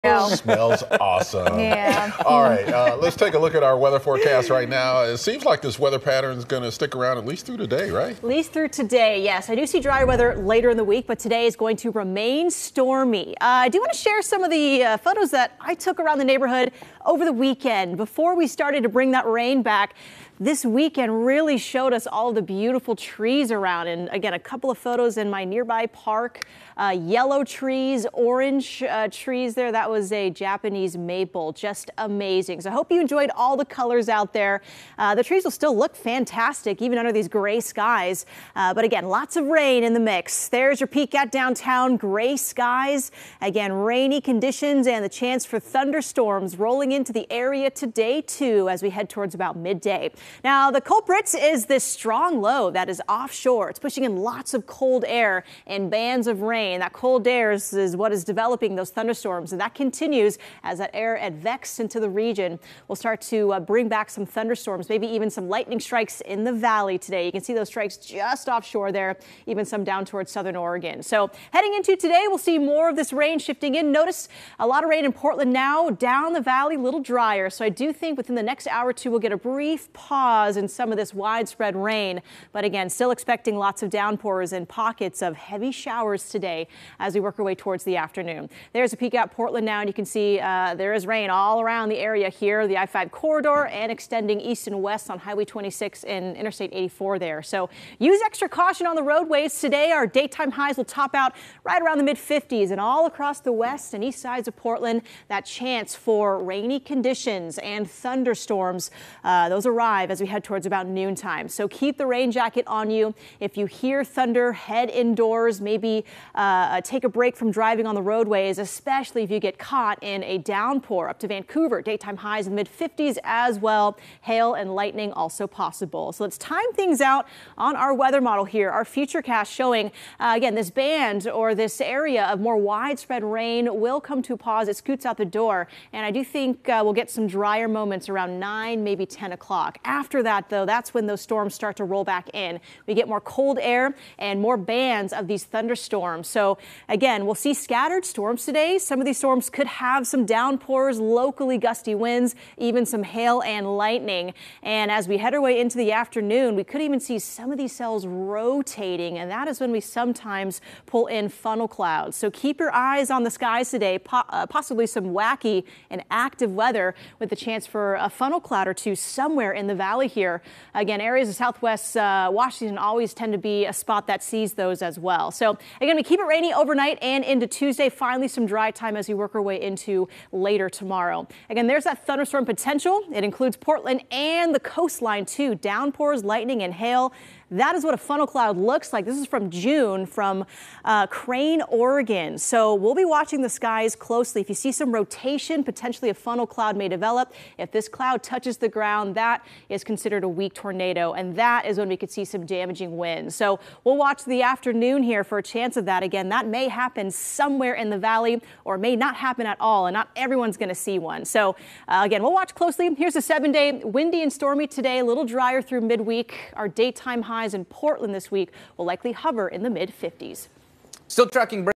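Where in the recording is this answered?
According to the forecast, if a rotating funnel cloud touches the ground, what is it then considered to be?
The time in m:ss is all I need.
3:20.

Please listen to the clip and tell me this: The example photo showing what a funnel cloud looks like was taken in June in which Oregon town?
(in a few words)
Crane, Oregon.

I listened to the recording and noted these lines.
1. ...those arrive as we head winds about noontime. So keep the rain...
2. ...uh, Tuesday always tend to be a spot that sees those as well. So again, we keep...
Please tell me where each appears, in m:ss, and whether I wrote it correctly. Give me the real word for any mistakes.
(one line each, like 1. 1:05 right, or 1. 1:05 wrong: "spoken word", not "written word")
1. 1:49 wrong: "towards", not "winds"
2. 2:51 wrong: "Washington", not "Tuesday".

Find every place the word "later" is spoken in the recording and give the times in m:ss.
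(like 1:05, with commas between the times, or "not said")
0:10, 3:00.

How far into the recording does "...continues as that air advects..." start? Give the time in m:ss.
0:59.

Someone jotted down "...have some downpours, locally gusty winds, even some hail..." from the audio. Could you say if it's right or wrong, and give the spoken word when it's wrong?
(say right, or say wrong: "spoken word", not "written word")
right.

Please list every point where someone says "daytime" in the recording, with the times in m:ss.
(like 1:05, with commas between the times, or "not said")
1:40, 2:01, 3:36.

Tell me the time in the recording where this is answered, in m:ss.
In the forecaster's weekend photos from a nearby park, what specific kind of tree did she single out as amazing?
0:30.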